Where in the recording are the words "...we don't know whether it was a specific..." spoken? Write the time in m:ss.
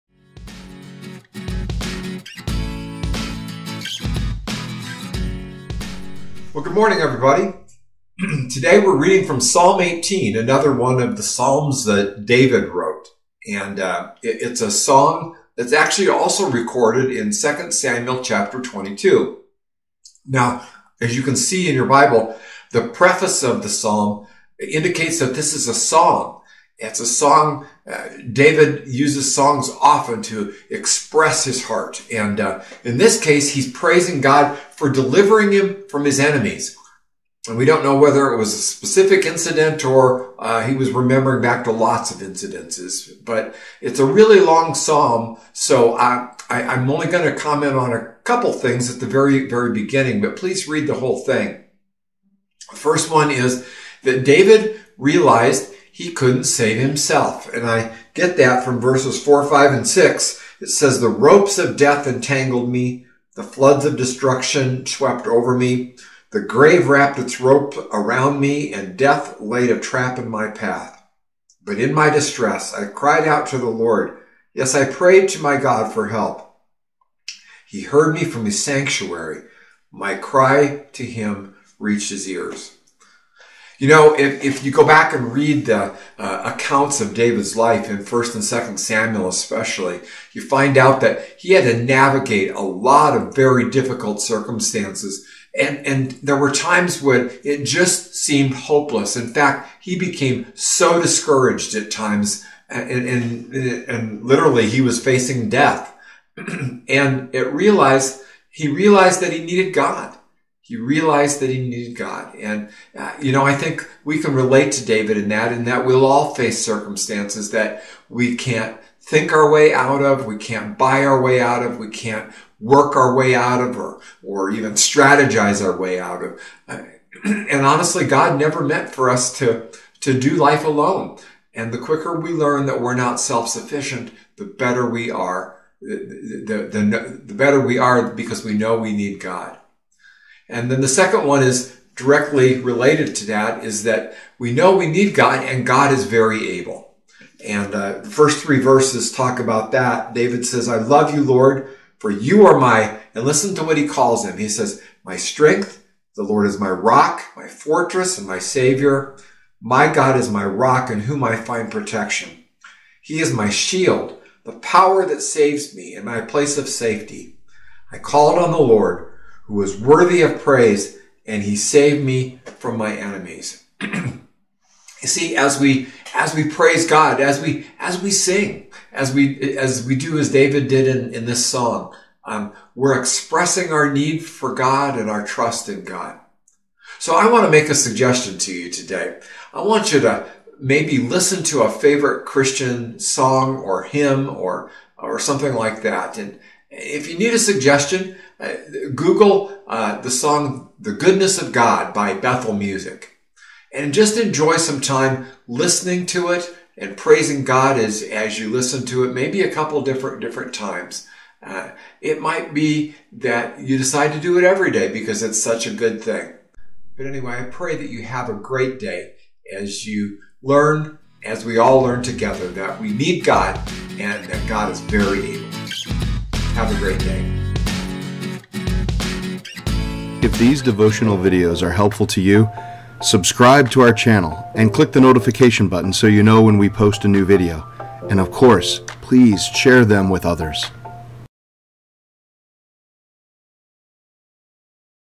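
0:37.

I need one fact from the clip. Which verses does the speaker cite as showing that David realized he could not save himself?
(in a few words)
4, 5, and 6.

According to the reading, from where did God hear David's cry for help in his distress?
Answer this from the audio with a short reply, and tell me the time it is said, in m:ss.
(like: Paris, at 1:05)
His sanctuary, at 1:18.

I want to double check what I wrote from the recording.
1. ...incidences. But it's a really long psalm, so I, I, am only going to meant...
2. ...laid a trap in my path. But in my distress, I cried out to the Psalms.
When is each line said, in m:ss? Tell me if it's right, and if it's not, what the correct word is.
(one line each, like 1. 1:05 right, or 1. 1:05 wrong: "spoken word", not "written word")
1. 0:42 wrong: "comment", not "meant"
2. 1:09 wrong: "Lord", not "Psalms".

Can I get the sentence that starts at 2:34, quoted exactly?
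He says, my strength, the Lord is my rock, my fortress, and my savior.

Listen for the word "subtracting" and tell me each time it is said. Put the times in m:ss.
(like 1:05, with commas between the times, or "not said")
not said.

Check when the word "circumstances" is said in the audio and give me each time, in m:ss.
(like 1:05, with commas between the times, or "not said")
1:34, 1:56.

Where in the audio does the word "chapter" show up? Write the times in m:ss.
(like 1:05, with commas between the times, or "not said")
0:18.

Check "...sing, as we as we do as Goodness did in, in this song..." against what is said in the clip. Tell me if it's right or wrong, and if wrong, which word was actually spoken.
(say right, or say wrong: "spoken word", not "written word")
wrong: "David", not "Goodness".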